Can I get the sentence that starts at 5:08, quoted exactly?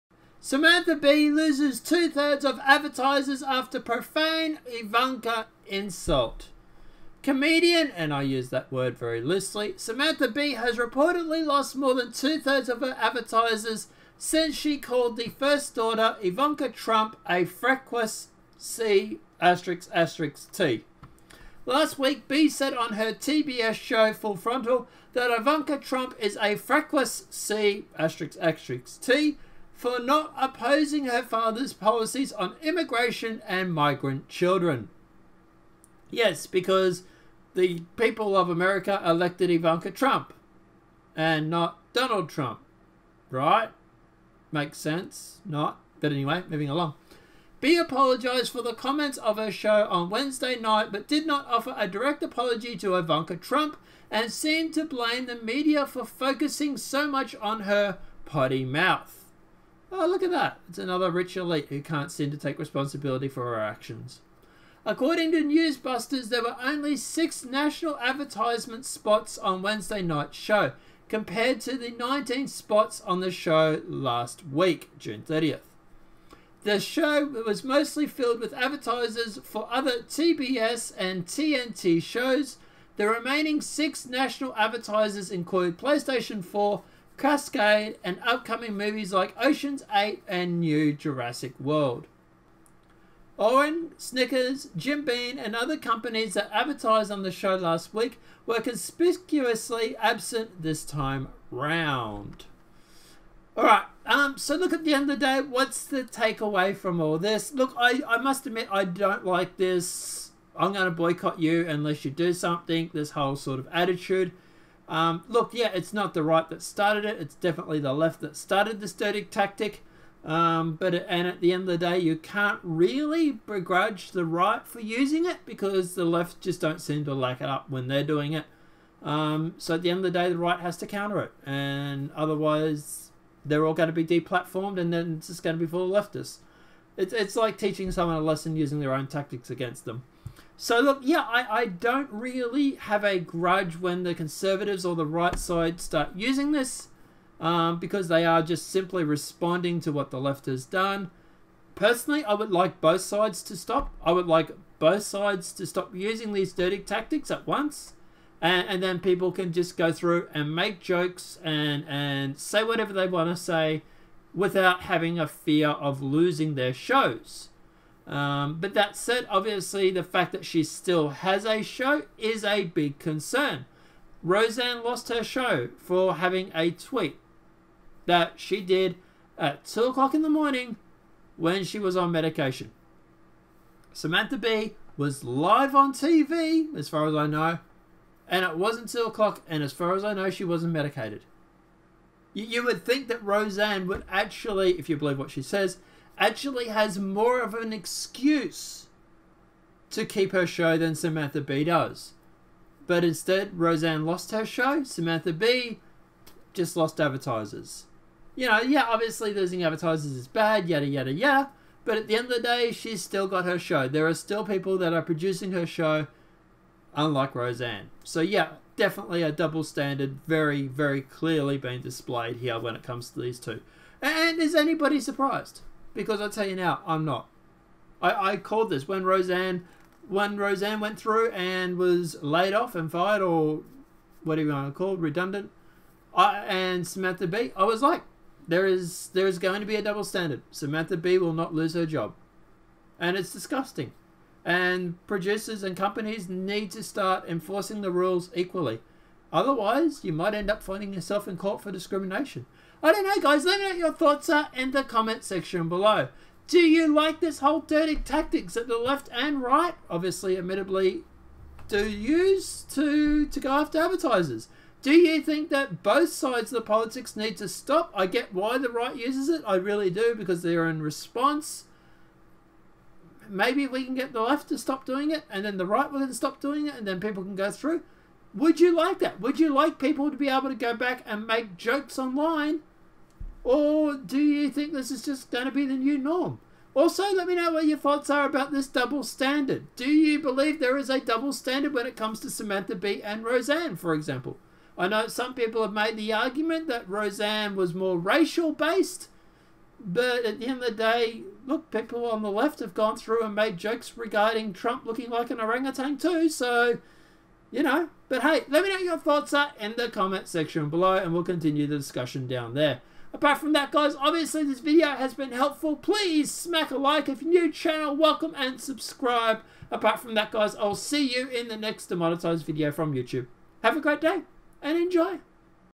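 But hey, let me know what your thoughts are in the comment section below, and we'll continue the discussion down there.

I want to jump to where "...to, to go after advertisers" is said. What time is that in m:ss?
4:22.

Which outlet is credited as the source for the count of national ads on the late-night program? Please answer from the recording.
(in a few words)
Newsbusters.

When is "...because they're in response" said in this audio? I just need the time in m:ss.
4:30.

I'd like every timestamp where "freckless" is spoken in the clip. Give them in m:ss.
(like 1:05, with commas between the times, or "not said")
0:17, 0:26.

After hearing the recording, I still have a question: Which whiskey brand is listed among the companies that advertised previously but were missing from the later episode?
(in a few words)
Jim Beam.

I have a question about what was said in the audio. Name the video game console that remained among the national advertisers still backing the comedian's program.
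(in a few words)
PlayStation 4.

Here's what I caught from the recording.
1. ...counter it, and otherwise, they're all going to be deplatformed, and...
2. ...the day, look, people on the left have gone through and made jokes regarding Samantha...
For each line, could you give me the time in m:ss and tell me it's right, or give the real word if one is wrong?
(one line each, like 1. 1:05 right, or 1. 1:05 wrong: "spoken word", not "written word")
1. 2:10 right
2. 5:00 wrong: "Trump", not "Samantha".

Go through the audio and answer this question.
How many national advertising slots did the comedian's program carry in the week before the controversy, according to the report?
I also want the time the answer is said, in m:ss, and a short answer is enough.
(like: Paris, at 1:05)
19, at 1:11.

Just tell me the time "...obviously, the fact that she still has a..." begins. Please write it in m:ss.
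2:49.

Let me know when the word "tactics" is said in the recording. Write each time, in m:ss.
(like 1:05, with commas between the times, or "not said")
1:59, 2:19, 2:36, 4:17.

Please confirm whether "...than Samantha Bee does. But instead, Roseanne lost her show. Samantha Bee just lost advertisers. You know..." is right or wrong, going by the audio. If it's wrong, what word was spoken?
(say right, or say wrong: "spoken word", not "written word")
right.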